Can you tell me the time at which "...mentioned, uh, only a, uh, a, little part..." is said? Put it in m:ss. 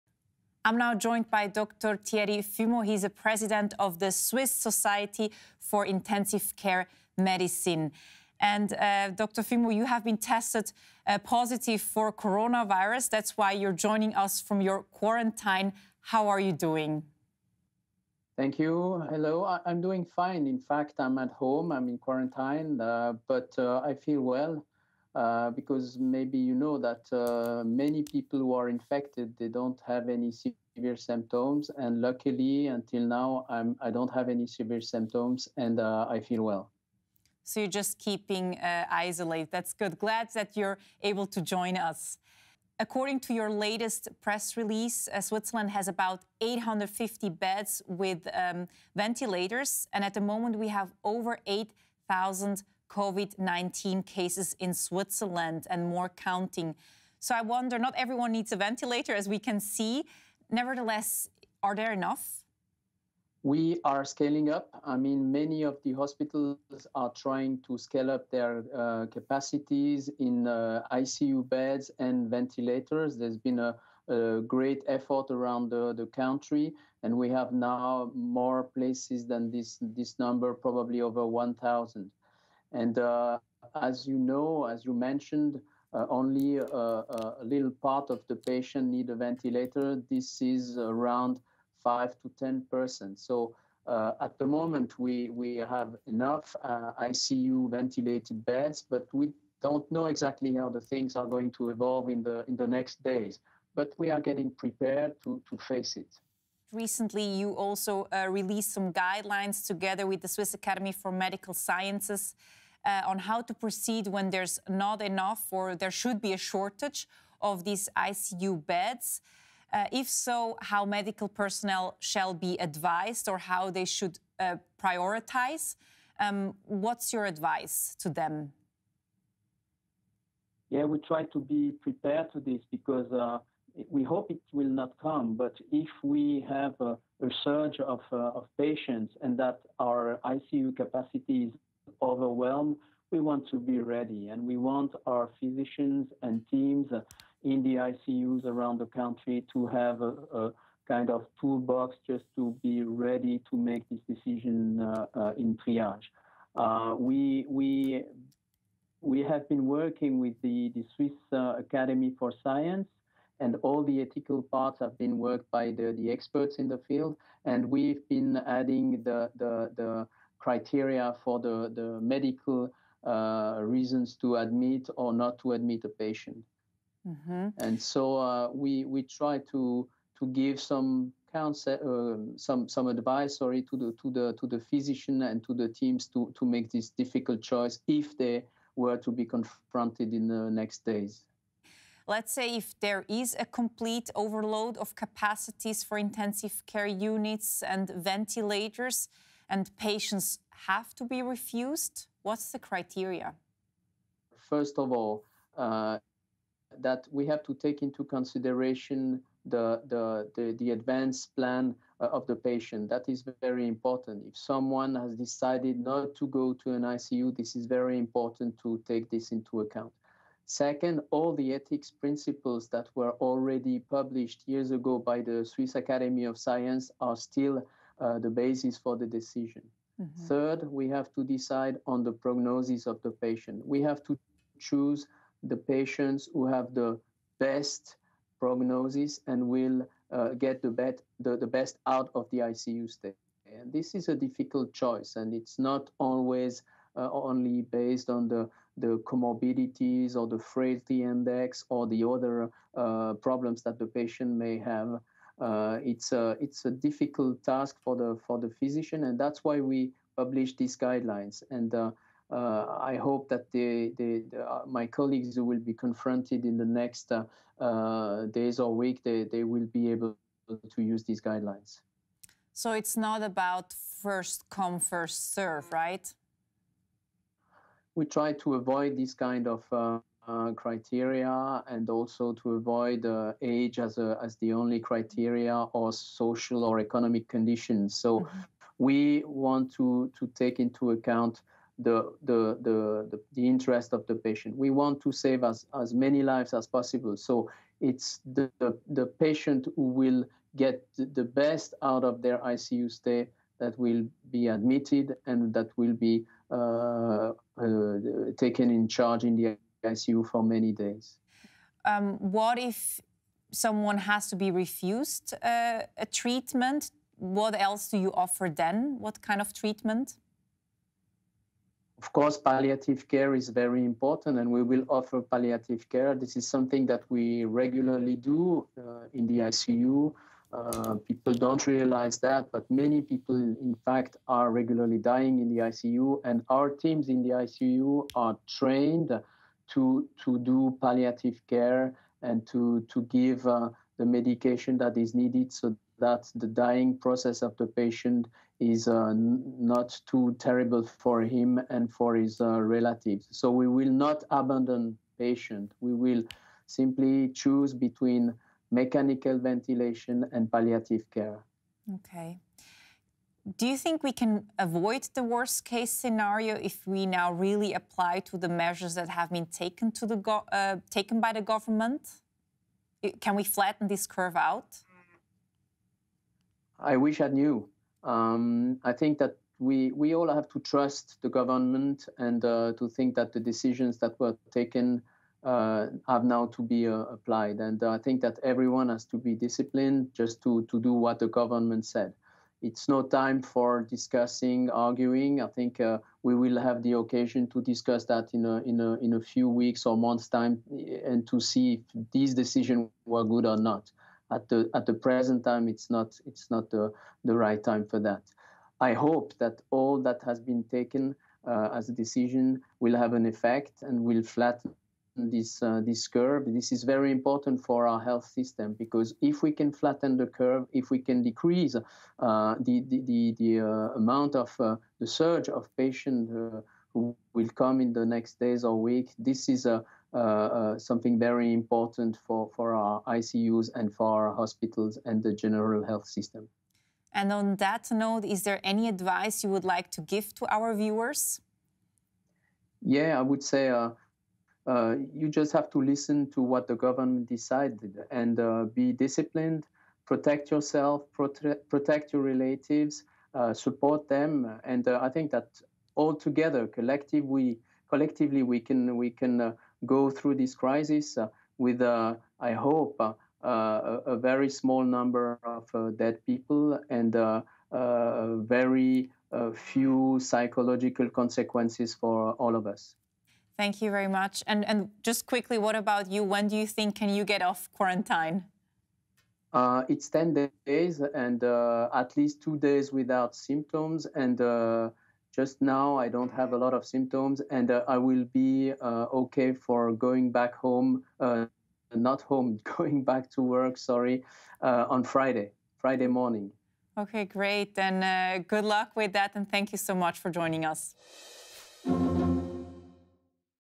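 1:24.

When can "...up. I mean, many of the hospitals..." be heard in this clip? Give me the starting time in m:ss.
1:04.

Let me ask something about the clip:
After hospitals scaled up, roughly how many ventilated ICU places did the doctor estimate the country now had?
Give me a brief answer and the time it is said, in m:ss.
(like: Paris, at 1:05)
over 1,000, at 1:21.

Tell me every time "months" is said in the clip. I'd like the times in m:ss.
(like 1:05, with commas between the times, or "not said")
6:39.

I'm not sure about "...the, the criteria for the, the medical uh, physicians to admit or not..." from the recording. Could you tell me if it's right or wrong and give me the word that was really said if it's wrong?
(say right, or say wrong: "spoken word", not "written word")
wrong: "reasons", not "physicians".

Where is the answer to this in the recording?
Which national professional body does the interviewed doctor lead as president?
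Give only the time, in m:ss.
0:04.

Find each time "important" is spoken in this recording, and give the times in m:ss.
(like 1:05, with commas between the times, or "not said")
3:33, 3:37, 5:23, 6:57, 7:11.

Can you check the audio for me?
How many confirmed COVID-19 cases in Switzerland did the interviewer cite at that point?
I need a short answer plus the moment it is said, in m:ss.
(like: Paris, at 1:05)
over 8,000, at 0:51.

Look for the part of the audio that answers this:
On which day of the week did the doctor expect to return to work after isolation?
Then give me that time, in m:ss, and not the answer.
8:15.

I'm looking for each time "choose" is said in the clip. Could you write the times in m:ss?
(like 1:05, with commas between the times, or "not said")
3:54, 5:57.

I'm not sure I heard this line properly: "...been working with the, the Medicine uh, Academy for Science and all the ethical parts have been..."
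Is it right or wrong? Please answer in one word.
wrong.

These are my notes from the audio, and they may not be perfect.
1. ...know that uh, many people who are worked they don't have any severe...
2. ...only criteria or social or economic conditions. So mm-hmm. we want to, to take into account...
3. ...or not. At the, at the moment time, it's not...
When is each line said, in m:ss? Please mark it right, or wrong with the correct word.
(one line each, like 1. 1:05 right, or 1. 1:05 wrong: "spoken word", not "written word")
1. 0:26 wrong: "infected", not "worked"
2. 4:44 right
3. 6:43 wrong: "present", not "moment".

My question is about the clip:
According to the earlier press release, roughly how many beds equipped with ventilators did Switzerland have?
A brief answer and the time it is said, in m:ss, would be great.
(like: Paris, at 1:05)
850, at 0:46.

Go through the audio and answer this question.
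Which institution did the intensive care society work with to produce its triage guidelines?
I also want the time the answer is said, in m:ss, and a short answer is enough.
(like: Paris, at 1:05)
Swiss Academy for Medical Sciences, at 1:50.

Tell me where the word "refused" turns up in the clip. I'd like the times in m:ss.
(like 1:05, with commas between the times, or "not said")
3:21, 5:14.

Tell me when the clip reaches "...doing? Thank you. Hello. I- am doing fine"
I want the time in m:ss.
0:16.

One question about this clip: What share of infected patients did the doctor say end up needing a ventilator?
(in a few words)
5 to 10 percent.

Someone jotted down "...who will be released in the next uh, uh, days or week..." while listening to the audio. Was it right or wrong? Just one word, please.
wrong.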